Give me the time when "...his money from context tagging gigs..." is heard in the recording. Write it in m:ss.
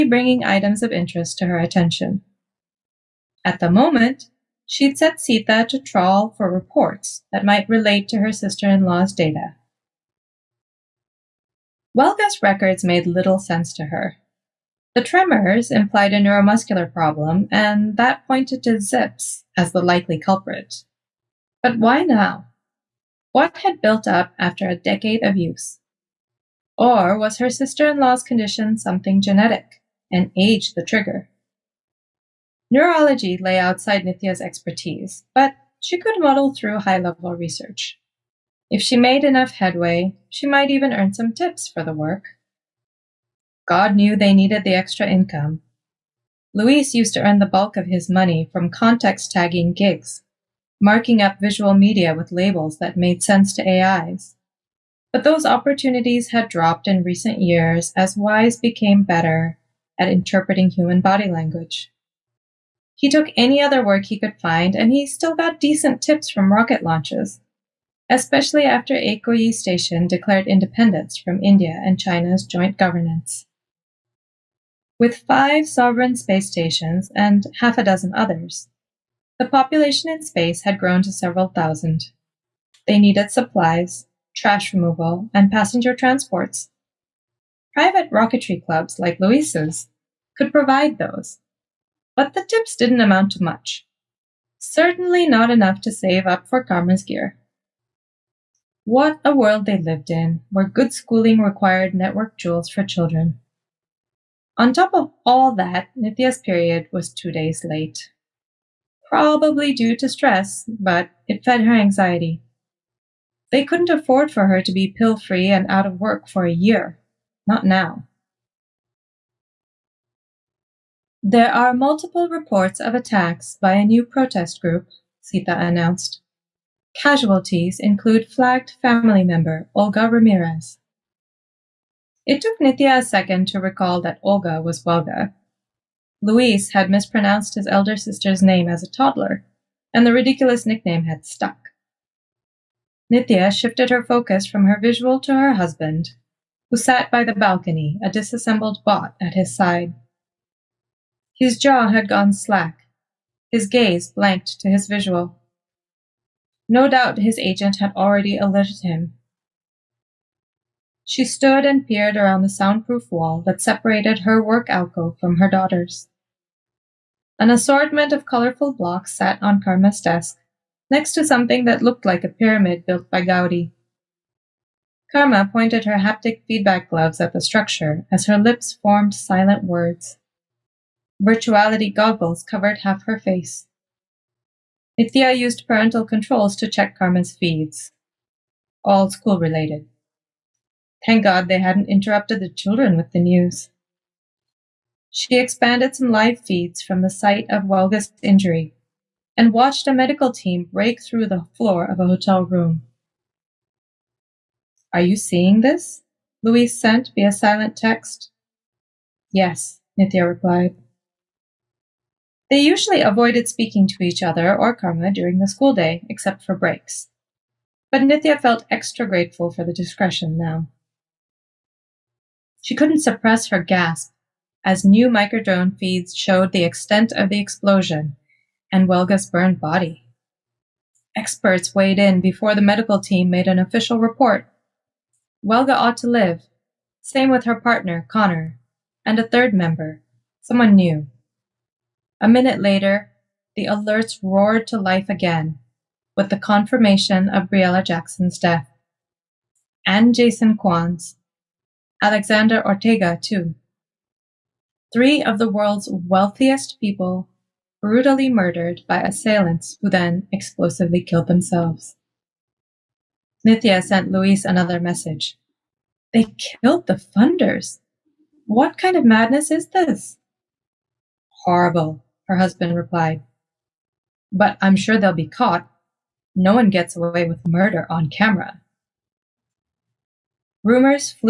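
0:47.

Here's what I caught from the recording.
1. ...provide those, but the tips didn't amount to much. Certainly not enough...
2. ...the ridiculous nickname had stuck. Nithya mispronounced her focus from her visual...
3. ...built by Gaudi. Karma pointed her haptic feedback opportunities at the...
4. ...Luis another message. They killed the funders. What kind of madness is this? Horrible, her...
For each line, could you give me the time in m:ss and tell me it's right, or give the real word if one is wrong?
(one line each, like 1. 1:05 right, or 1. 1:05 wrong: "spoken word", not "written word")
1. 1:30 right
2. 2:20 wrong: "shifted", not "mispronounced"
3. 2:52 wrong: "gloves", not "opportunities"
4. 4:24 right.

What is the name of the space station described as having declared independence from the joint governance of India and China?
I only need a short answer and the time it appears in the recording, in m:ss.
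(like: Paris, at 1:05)
Ekoyi Station, at 1:08.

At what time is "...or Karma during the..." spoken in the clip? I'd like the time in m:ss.
3:34.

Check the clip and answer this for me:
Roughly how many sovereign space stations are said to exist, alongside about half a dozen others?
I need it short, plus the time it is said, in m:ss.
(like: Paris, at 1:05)
5, at 1:15.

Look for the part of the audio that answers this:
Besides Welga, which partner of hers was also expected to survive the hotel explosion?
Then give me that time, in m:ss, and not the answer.
3:58.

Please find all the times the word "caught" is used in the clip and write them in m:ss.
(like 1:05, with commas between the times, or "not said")
4:35.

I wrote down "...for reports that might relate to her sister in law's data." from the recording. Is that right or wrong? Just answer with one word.
right.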